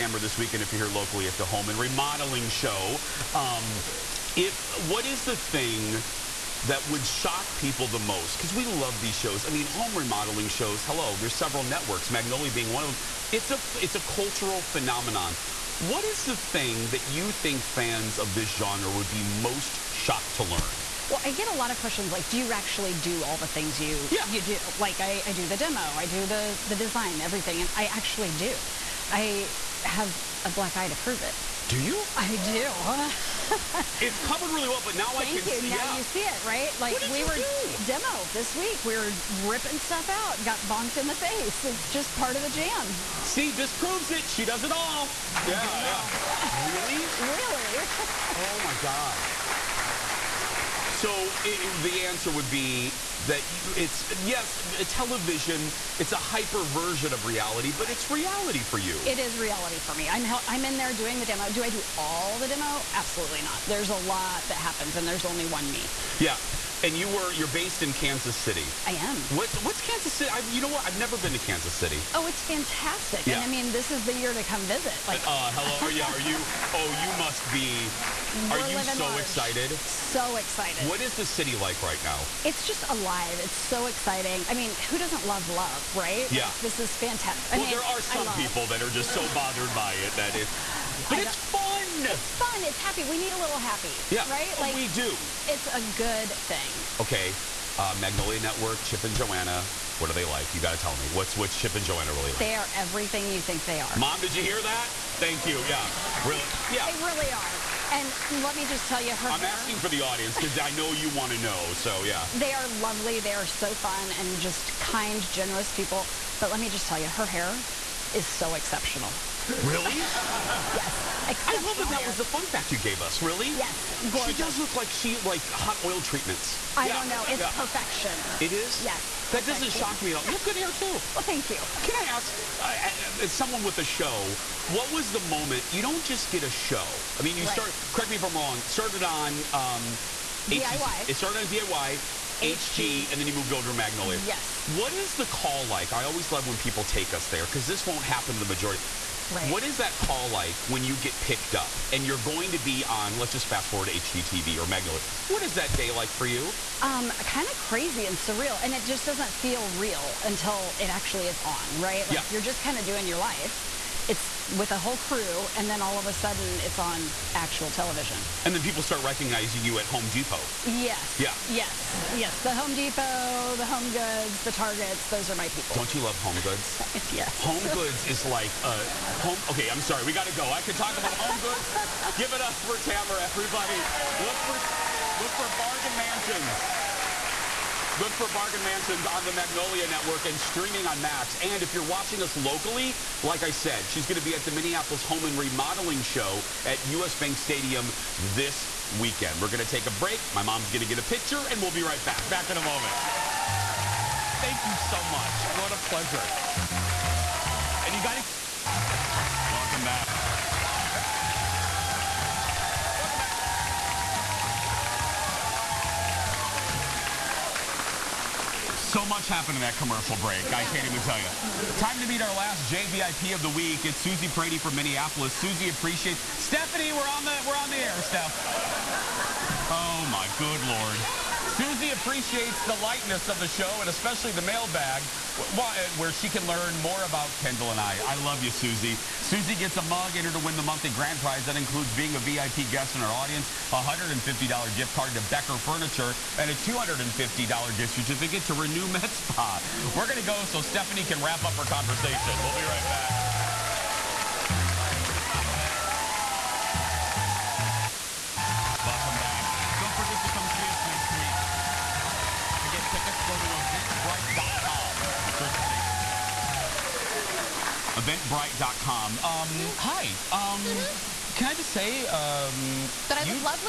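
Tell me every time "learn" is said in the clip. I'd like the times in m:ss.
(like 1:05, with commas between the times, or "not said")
0:20, 3:56.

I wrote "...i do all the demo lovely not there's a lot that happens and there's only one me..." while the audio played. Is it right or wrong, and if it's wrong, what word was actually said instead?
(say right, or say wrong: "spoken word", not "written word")
wrong: "absolutely", not "lovely".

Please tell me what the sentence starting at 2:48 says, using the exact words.
And then people start recognizing you at Home Depot.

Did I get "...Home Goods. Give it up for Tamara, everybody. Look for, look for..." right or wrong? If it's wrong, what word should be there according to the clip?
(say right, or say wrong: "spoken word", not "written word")
right.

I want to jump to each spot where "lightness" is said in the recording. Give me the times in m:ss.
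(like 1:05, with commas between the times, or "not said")
3:52.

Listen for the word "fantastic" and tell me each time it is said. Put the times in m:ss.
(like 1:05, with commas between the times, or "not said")
1:12, 1:26.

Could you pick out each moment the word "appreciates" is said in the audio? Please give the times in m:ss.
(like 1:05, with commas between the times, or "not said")
3:45, 3:51.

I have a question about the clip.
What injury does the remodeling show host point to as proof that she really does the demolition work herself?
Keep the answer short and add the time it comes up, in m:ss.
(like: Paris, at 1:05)
black eye, at 0:30.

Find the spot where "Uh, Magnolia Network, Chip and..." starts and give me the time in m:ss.
1:37.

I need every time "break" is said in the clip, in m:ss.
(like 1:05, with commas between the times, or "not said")
3:19, 3:40.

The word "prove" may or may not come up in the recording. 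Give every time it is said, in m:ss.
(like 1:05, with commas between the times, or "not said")
0:30, 0:43.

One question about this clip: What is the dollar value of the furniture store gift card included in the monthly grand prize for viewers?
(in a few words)
$150.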